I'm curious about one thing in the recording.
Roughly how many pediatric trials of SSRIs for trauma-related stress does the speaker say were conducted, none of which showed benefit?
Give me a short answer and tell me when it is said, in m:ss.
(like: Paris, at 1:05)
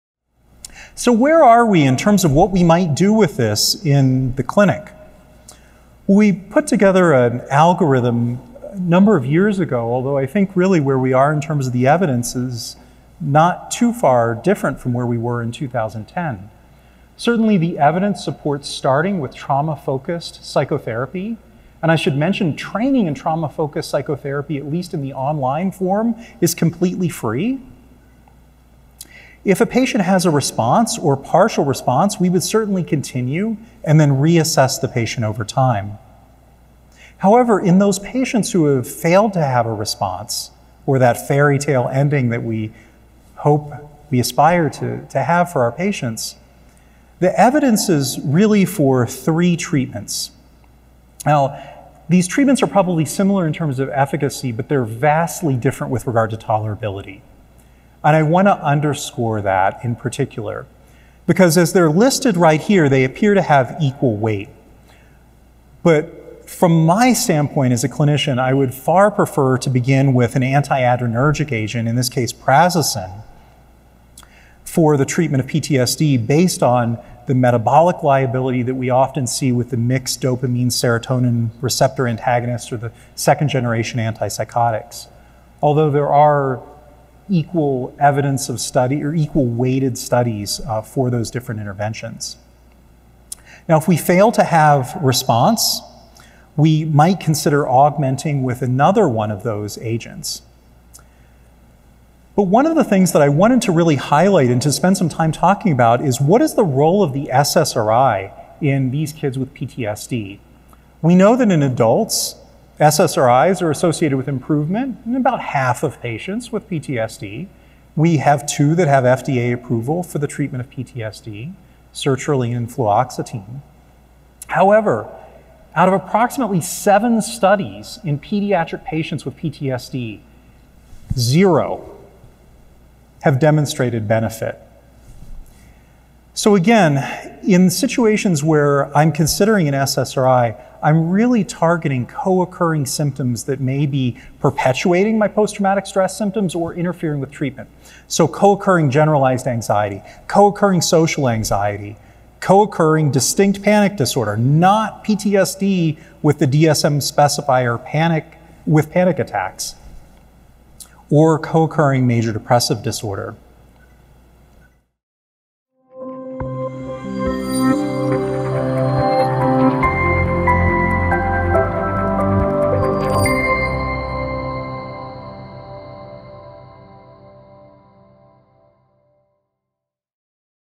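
7, at 2:06.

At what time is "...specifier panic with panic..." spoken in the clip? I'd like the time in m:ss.
2:36.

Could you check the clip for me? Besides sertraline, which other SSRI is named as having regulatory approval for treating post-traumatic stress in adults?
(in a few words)
fluoxetine.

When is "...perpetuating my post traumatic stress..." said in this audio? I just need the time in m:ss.
2:24.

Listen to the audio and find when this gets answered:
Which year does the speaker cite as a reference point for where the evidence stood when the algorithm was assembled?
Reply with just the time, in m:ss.
0:15.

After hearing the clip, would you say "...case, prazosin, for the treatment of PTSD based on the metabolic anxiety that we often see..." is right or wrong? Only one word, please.
wrong.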